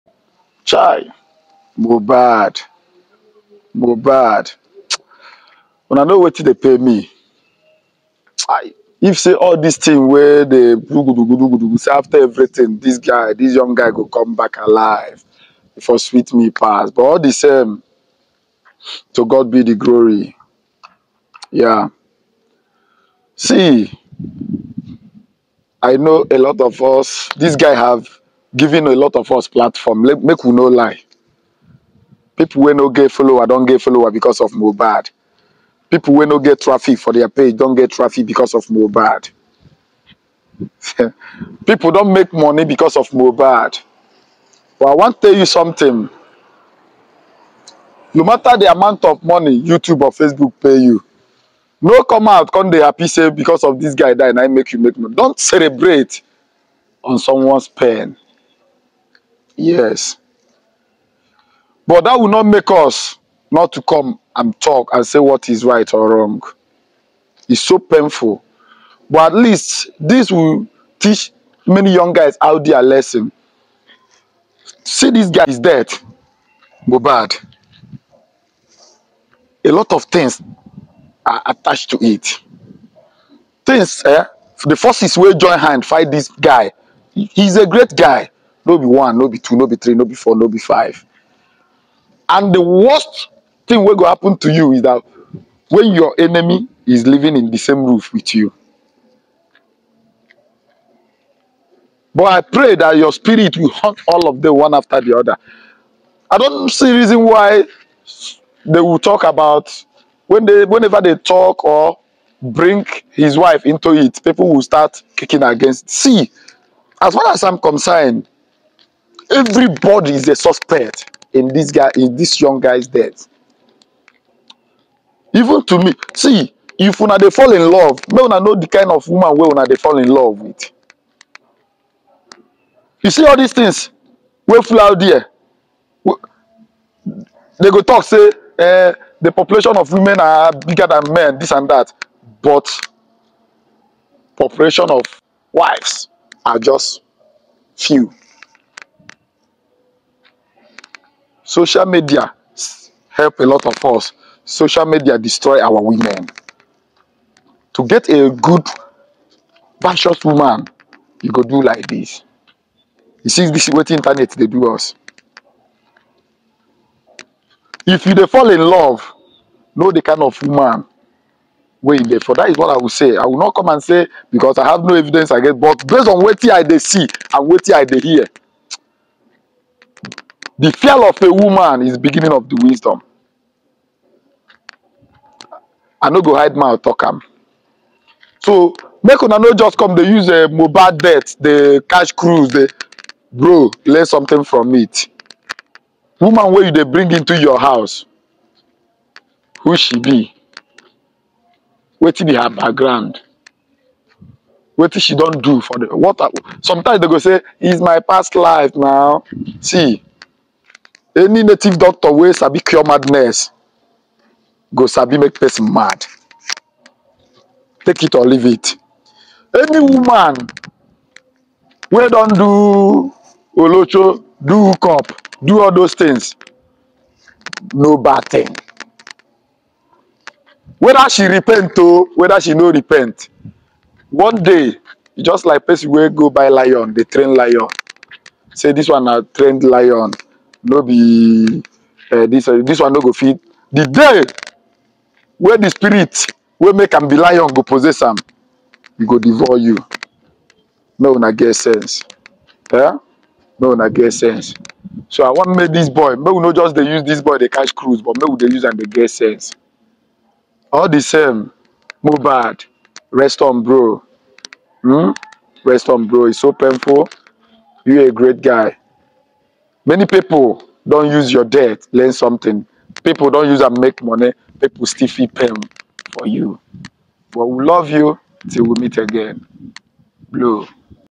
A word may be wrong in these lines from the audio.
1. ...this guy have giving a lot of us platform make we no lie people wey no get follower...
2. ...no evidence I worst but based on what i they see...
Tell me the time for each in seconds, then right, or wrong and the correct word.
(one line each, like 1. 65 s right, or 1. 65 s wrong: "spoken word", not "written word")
1. 27 s right
2. 174 s wrong: "against", not "worst".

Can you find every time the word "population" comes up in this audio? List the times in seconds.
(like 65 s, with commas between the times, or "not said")
139 s, 144 s.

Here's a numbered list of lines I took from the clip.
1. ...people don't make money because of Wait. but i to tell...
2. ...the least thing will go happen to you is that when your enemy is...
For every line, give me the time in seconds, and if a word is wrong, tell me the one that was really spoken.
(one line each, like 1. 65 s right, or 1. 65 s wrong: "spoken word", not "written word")
1. 41 s wrong: "Mohbad", not "Wait"
2. 92 s wrong: "worst", not "least".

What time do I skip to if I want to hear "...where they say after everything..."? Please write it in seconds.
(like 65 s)
10 s.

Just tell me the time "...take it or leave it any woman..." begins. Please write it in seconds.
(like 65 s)
217 s.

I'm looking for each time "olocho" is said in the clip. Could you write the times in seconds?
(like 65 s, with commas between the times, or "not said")
223 s.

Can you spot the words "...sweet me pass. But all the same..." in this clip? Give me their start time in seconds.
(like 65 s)
15 s.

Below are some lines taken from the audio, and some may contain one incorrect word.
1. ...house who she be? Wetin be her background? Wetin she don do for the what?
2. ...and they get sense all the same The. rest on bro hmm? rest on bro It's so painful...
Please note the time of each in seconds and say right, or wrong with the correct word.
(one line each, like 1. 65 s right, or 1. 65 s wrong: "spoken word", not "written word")
1. 197 s right
2. 258 s wrong: "Mohbad", not "The".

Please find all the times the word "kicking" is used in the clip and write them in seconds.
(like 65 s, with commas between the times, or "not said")
115 s.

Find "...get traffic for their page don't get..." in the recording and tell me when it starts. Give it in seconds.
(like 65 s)
36 s.